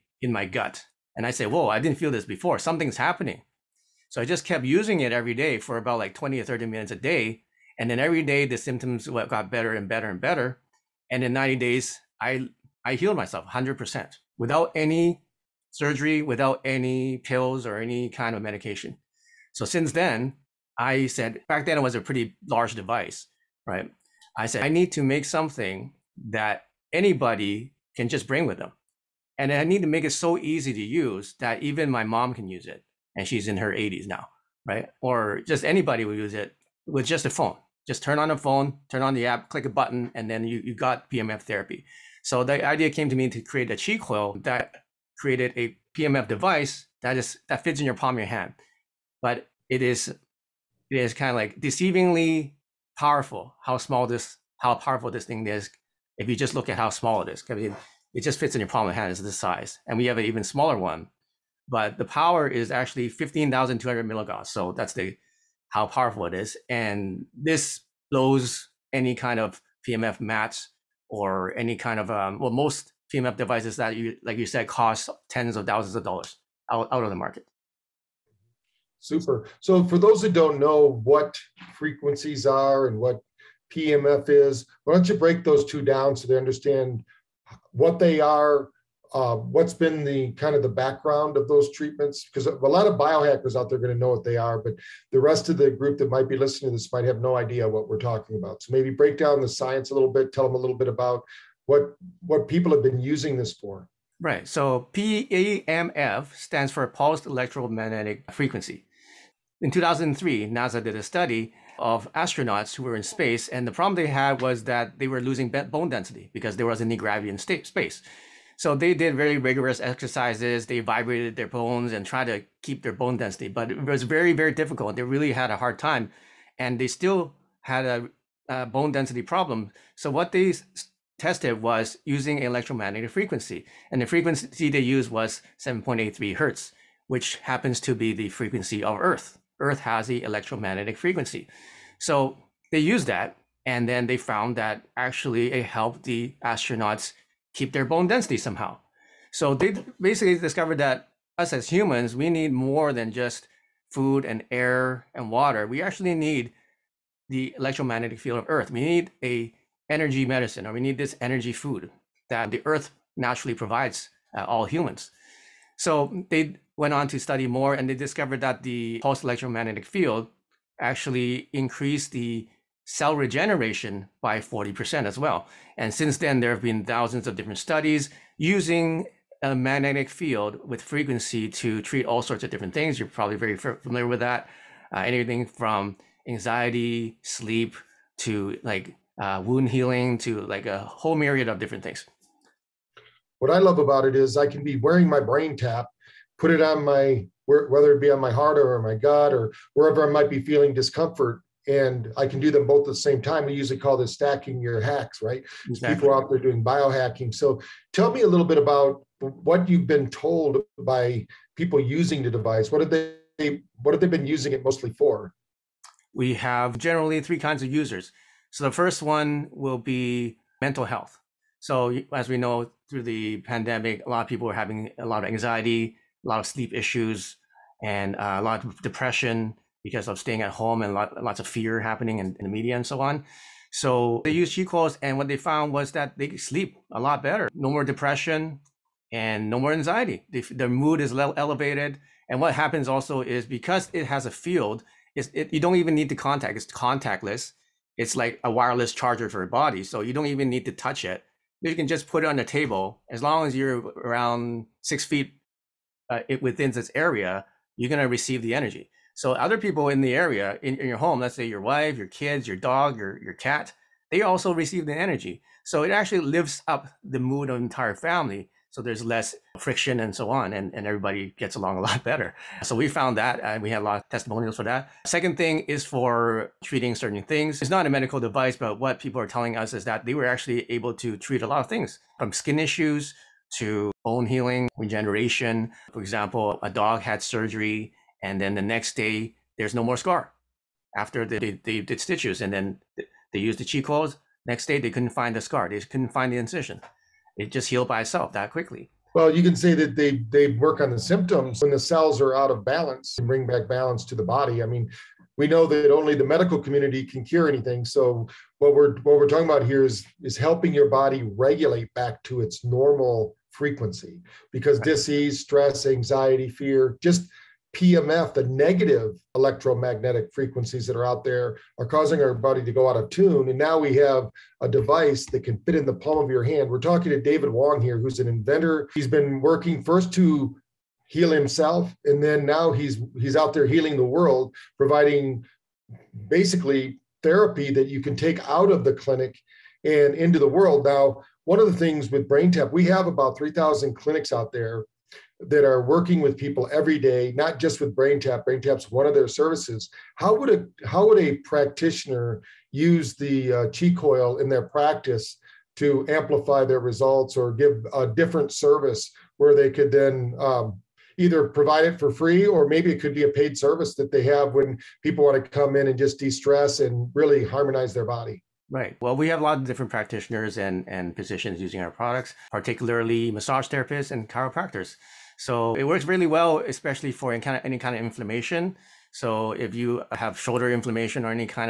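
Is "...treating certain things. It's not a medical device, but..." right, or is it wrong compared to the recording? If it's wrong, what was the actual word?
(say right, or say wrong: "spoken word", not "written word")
right.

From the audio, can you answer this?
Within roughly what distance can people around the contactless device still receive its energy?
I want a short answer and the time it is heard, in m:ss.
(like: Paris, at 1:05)
six feet, at 4:14.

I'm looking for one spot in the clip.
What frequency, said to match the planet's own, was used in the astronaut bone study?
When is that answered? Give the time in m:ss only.
2:15.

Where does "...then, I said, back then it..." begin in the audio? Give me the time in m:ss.
0:19.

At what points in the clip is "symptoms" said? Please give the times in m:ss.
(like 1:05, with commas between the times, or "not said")
0:08, 5:00.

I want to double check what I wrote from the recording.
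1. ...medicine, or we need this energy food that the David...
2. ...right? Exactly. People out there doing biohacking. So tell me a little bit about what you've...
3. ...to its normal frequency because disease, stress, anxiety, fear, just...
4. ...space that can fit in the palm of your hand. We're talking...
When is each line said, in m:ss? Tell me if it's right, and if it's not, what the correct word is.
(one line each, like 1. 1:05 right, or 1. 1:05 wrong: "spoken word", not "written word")
1. 2:40 wrong: "Earth", not "David"
2. 3:25 right
3. 5:12 right
4. 5:24 wrong: "device", not "space".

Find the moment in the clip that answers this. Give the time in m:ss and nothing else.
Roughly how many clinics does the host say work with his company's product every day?
5:43.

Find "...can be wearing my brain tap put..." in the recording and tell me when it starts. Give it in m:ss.
3:14.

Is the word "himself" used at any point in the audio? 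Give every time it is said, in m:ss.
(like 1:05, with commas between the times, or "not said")
5:31.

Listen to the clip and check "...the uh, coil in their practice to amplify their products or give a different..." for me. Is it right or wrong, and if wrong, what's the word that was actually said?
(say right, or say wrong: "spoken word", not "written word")
wrong: "results", not "products".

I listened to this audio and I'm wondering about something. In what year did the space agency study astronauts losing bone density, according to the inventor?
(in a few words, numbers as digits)
2003.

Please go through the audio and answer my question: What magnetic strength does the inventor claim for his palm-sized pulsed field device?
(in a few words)
15,200 milligauss.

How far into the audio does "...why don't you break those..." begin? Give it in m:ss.
1:24.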